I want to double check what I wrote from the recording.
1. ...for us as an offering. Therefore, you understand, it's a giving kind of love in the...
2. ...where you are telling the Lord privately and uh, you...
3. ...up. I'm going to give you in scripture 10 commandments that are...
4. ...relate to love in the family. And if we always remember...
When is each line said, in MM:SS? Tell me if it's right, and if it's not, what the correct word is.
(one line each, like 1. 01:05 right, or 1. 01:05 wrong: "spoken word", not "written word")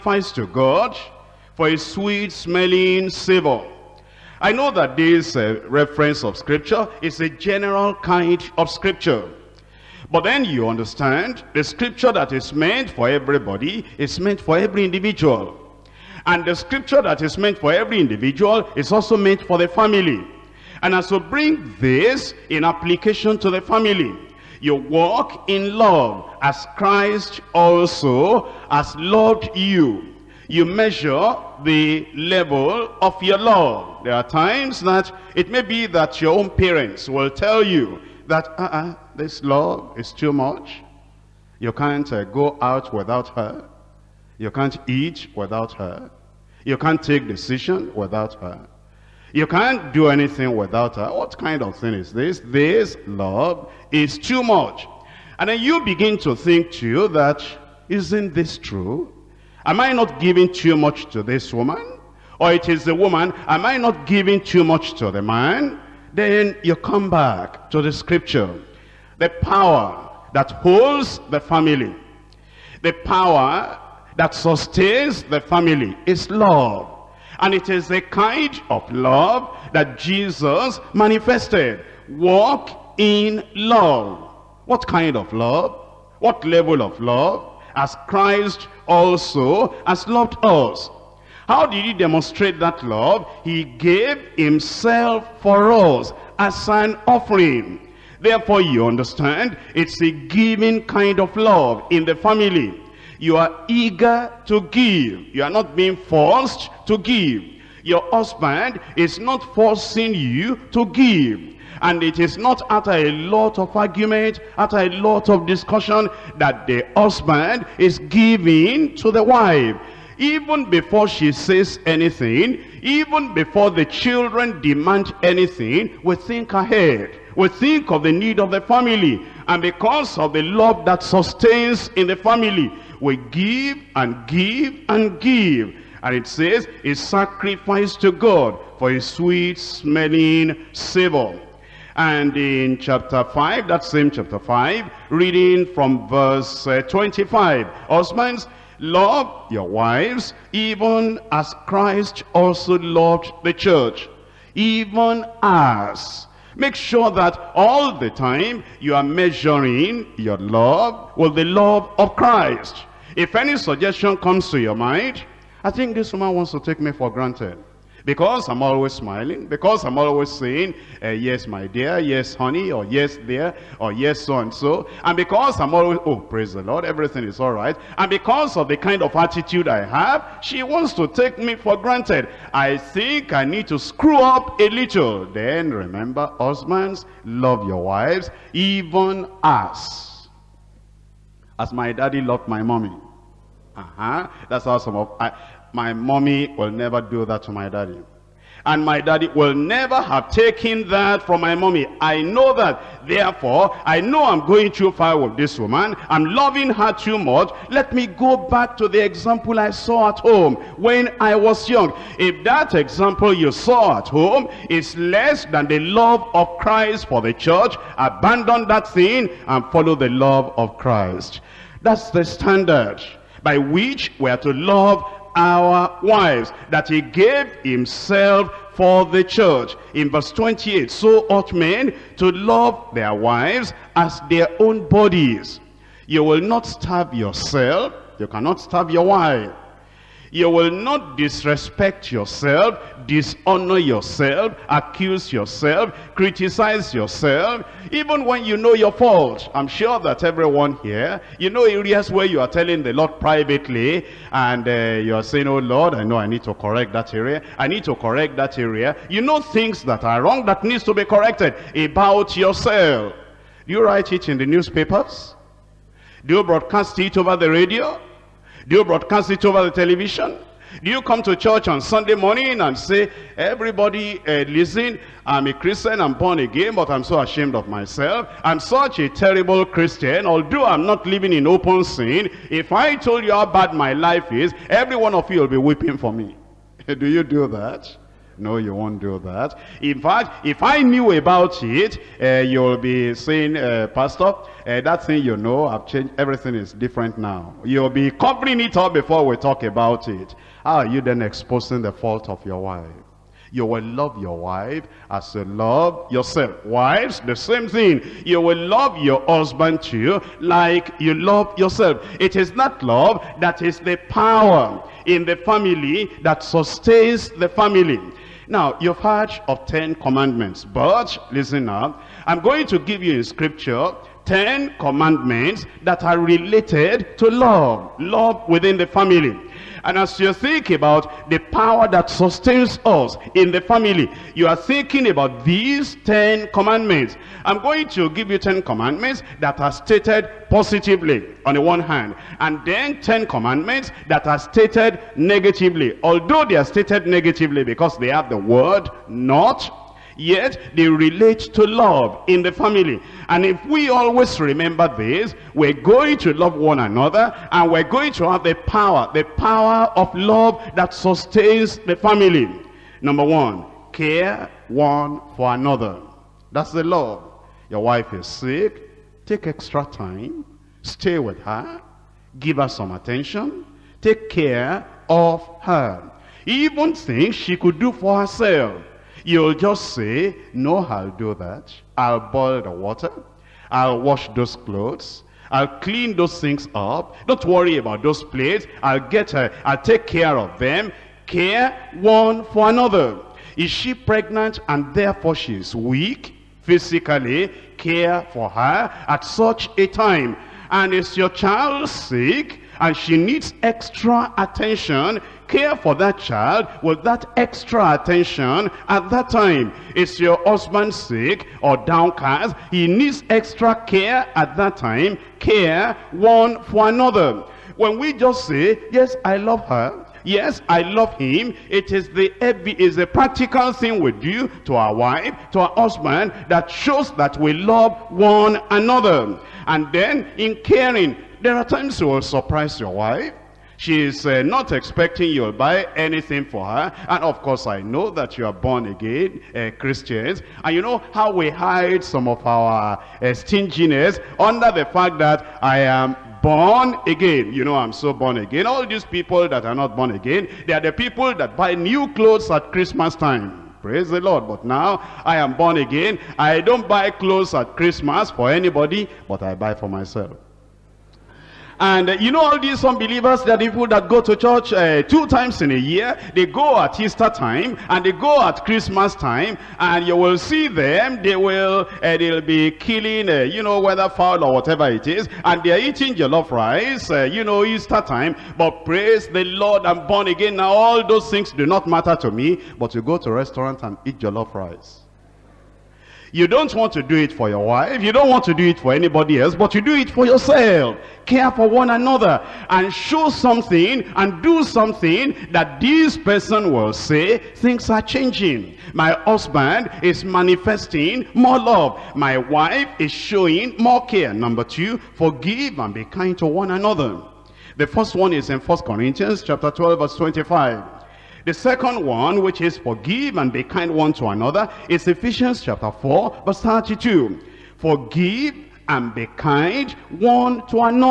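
1. 01:35 right
2. 04:12 right
3. 05:21 right
4. 05:50 right.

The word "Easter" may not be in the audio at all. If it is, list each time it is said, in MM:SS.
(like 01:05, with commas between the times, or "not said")
07:47, 07:57.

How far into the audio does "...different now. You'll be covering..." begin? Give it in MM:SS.
04:56.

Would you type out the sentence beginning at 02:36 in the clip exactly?
Make sure that all the time you are measuring your love with the love of Christ.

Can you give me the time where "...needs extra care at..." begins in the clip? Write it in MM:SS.
06:52.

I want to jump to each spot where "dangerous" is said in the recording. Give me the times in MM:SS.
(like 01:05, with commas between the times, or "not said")
not said.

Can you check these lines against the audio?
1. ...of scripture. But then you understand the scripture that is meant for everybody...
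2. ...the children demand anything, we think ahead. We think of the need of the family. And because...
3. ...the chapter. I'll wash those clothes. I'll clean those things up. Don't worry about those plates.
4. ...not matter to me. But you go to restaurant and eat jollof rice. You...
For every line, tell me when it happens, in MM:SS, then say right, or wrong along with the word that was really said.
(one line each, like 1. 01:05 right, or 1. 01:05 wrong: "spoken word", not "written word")
1. 00:08 right
2. 02:03 right
3. 06:22 wrong: "water", not "chapter"
4. 08:01 right.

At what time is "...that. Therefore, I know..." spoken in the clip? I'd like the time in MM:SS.
03:22.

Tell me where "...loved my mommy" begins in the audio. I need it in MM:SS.
03:12.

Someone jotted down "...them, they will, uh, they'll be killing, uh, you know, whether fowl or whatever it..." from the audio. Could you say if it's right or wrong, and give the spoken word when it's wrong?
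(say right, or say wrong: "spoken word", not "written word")
right.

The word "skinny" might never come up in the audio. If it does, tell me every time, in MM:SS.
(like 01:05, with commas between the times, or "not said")
not said.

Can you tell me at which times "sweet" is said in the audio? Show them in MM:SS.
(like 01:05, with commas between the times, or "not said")
00:01, 02:19.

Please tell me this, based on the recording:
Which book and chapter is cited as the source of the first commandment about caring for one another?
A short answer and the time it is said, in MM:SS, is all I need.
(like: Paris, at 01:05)
1 Corinthians 12, at 08:28.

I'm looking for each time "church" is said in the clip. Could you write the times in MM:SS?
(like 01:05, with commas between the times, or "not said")
02:33, 03:37, 03:49, 04:31, 07:44.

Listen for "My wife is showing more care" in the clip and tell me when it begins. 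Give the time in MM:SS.
08:22.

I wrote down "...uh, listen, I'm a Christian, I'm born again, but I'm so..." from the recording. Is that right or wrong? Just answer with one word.
right.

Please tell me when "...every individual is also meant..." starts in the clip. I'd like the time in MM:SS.
00:17.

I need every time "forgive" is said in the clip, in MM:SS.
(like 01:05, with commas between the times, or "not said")
08:25, 08:32, 08:37.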